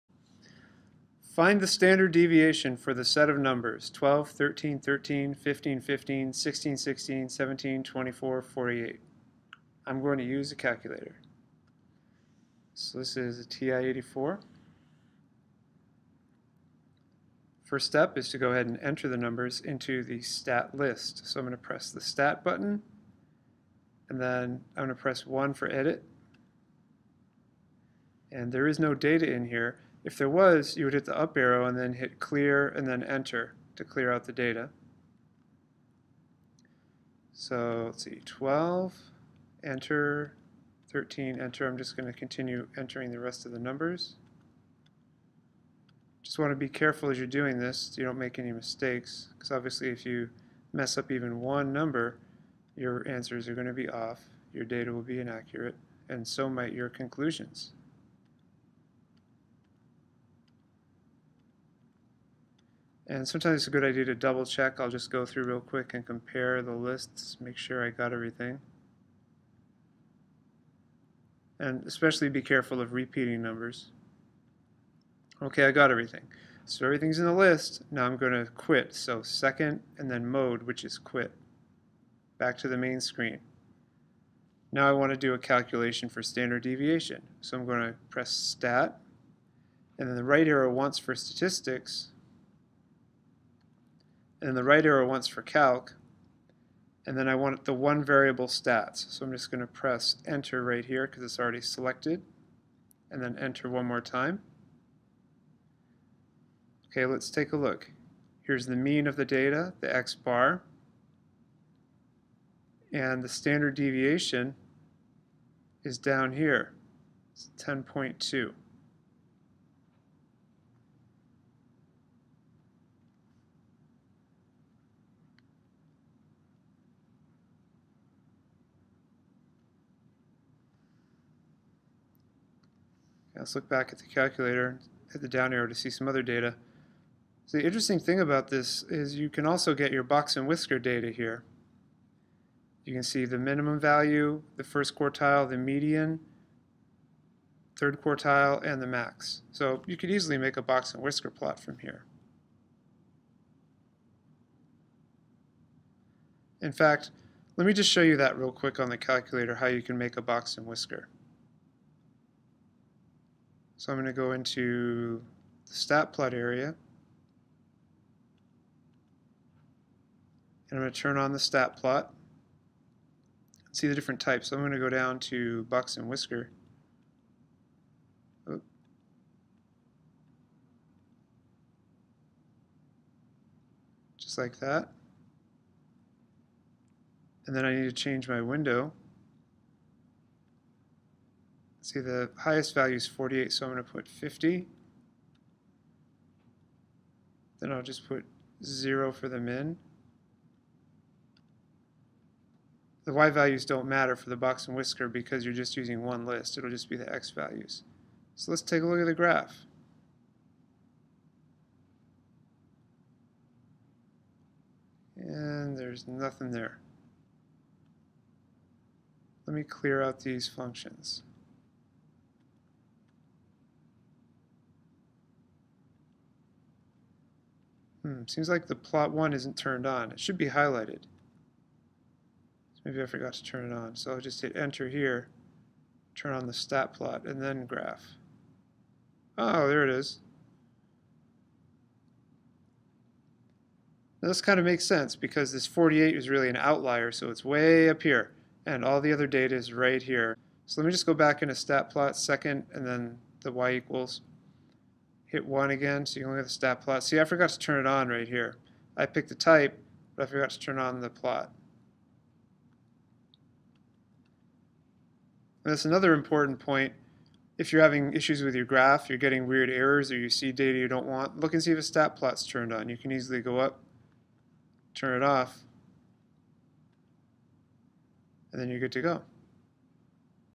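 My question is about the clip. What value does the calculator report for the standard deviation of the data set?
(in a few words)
10.2.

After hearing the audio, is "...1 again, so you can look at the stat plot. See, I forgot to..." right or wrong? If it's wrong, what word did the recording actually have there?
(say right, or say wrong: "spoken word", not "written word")
right.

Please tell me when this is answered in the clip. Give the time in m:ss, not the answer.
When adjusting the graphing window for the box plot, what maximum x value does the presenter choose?
3:14.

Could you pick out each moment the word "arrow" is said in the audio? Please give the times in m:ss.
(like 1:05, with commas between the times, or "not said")
0:31, 1:30, 1:34, 2:15.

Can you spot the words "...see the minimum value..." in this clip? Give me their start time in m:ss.
2:23.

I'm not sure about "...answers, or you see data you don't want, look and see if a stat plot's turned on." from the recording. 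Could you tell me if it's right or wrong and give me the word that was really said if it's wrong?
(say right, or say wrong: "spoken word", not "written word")
wrong: "errors", not "answers".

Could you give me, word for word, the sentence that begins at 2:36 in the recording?
In fact, let me just show you that real quick on the calculator, how you can make a box and whisker.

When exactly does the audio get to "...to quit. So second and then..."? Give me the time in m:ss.
1:18.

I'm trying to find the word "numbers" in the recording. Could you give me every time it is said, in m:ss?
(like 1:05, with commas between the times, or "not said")
0:03, 0:19, 0:43, 0:51, 1:13.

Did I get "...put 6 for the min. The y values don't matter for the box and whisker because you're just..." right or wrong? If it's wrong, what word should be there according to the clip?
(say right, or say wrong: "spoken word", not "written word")
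wrong: "0", not "6".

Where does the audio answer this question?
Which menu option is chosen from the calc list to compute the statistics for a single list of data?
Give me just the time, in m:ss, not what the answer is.
1:37.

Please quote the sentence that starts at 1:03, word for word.
And sometimes it's a good idea to double check.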